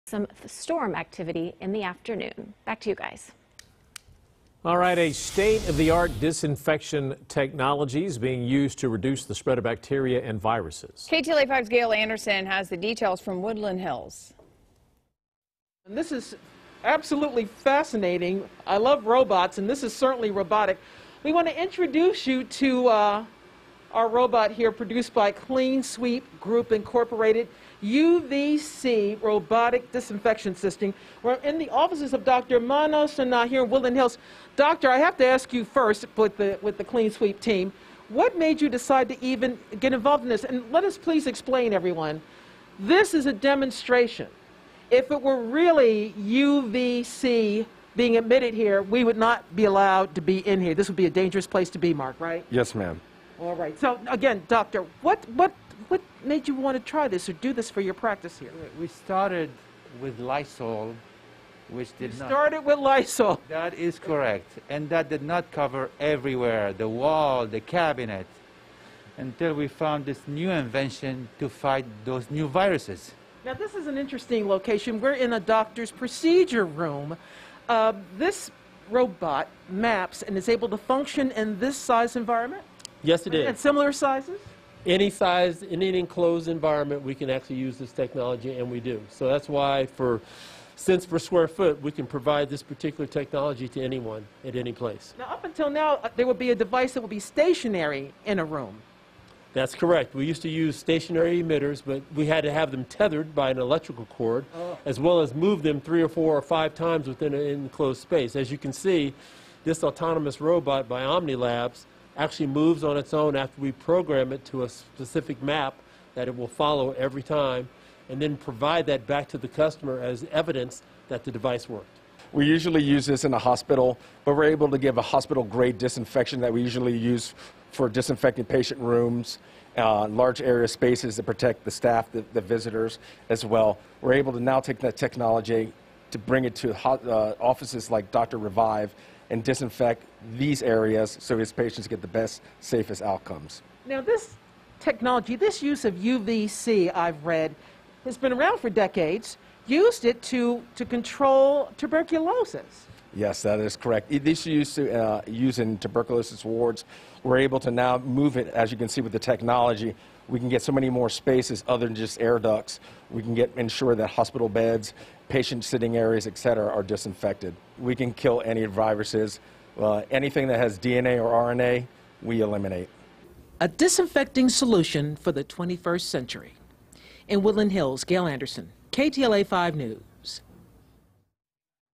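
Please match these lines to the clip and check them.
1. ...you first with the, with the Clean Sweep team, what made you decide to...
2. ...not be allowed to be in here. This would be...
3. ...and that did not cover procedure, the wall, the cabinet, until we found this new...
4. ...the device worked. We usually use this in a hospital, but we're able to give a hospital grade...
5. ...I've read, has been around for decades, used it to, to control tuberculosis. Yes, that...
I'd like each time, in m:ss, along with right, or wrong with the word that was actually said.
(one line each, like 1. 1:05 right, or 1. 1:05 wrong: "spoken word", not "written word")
1. 0:35 right
2. 0:49 right
3. 1:04 wrong: "everywhere", not "procedure"
4. 2:01 right
5. 2:26 right.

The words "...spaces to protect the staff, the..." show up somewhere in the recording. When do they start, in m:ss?
2:10.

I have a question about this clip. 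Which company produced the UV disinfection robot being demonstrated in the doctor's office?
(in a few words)
Clean Sweep Group Incorporated.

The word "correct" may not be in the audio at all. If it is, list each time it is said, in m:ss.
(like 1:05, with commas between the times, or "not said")
1:03, 1:39, 2:33.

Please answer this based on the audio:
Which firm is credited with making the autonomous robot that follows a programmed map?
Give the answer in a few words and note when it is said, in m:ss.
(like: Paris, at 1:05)
OhmniLabs, at 1:51.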